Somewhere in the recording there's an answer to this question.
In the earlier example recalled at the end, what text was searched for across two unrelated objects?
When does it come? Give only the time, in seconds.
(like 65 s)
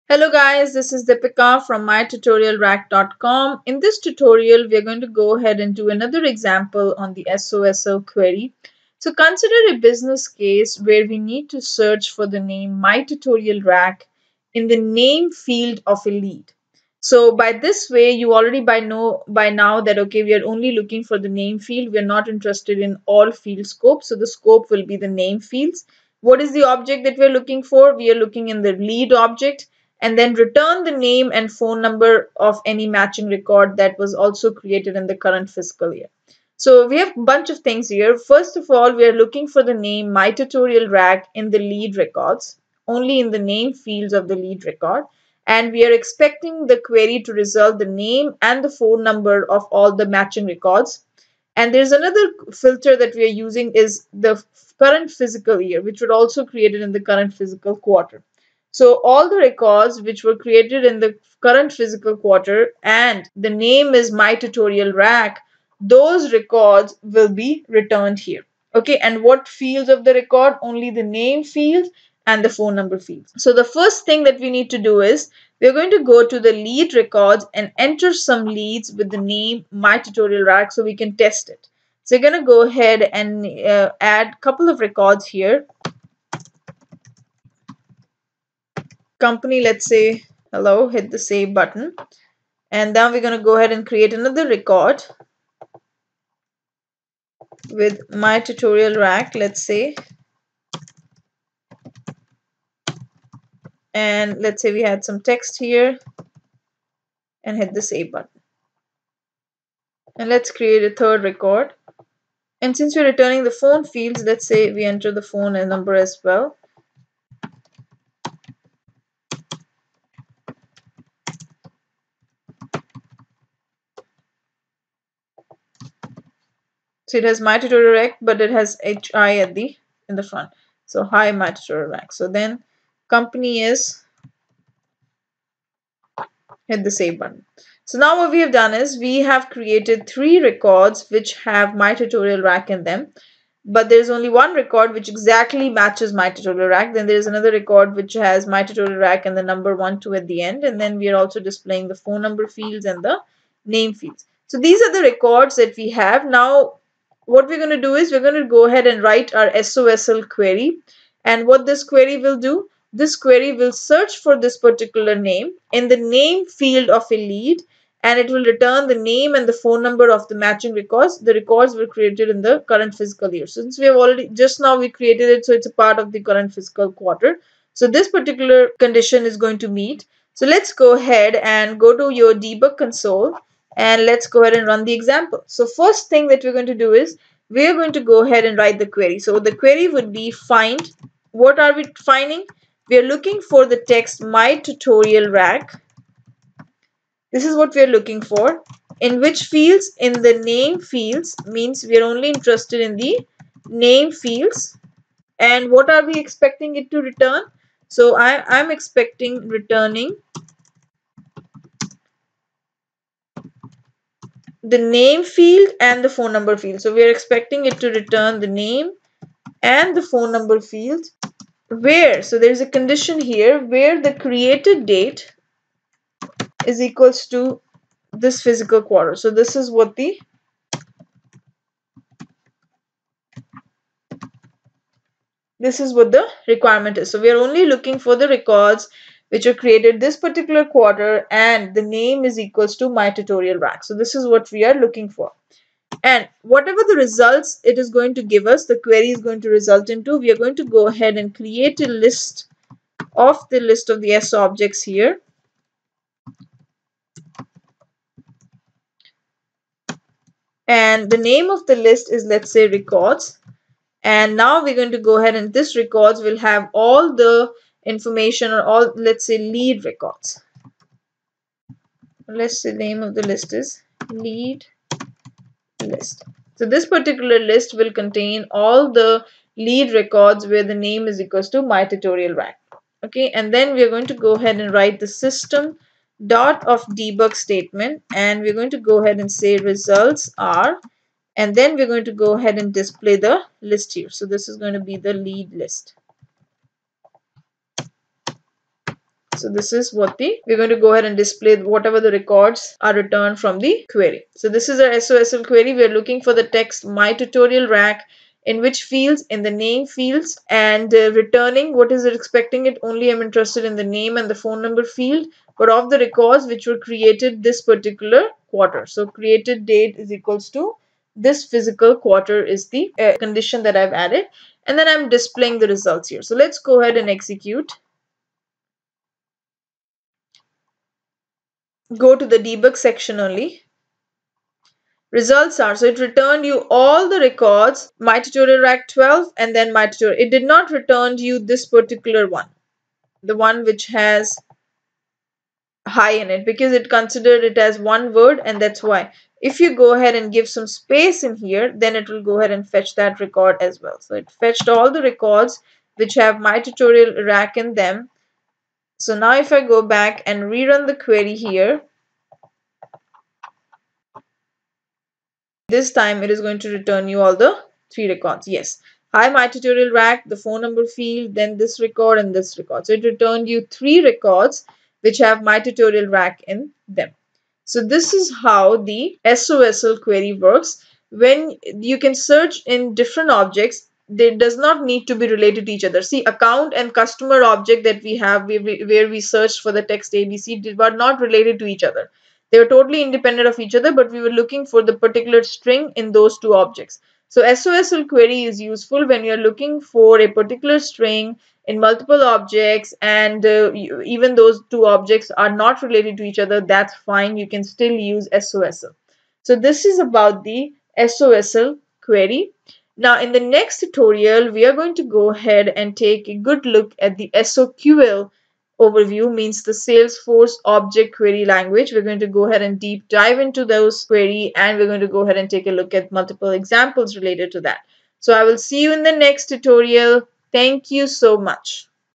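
390 s.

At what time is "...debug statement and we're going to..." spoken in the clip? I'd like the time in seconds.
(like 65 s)
286 s.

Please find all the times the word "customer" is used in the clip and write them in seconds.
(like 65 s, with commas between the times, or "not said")
386 s.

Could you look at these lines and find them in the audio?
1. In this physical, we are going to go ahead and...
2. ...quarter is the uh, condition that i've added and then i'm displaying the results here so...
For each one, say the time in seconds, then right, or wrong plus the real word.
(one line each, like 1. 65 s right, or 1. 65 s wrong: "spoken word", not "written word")
1. 3 s wrong: "tutorial", not "physical"
2. 321 s right.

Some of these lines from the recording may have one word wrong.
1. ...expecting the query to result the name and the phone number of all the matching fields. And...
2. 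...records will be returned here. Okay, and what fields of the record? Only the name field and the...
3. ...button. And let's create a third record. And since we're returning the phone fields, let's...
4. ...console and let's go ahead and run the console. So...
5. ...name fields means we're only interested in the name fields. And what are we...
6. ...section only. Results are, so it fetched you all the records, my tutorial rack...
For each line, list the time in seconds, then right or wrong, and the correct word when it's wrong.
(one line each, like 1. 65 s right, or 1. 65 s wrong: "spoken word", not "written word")
1. 45 s wrong: "records", not "fields"
2. 66 s right
3. 108 s right
4. 182 s wrong: "example", not "console"
5. 200 s right
6. 332 s wrong: "returned", not "fetched".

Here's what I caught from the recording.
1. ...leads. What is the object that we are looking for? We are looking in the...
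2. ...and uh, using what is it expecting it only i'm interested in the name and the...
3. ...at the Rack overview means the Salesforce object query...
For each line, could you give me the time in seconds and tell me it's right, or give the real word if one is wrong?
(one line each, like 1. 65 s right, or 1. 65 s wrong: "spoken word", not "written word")
1. 25 s wrong: "fields", not "leads"
2. 310 s wrong: "returning", not "using"
3. 416 s wrong: "SOQL", not "Rack".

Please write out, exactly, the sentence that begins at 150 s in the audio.
And then we are also displaying the phone number fields and the name fields.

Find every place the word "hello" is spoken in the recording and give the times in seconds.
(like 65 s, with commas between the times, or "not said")
0 s, 90 s.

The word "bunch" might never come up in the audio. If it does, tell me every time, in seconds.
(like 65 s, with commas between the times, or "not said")
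37 s.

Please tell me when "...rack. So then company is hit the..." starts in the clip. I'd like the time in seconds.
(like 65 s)
131 s.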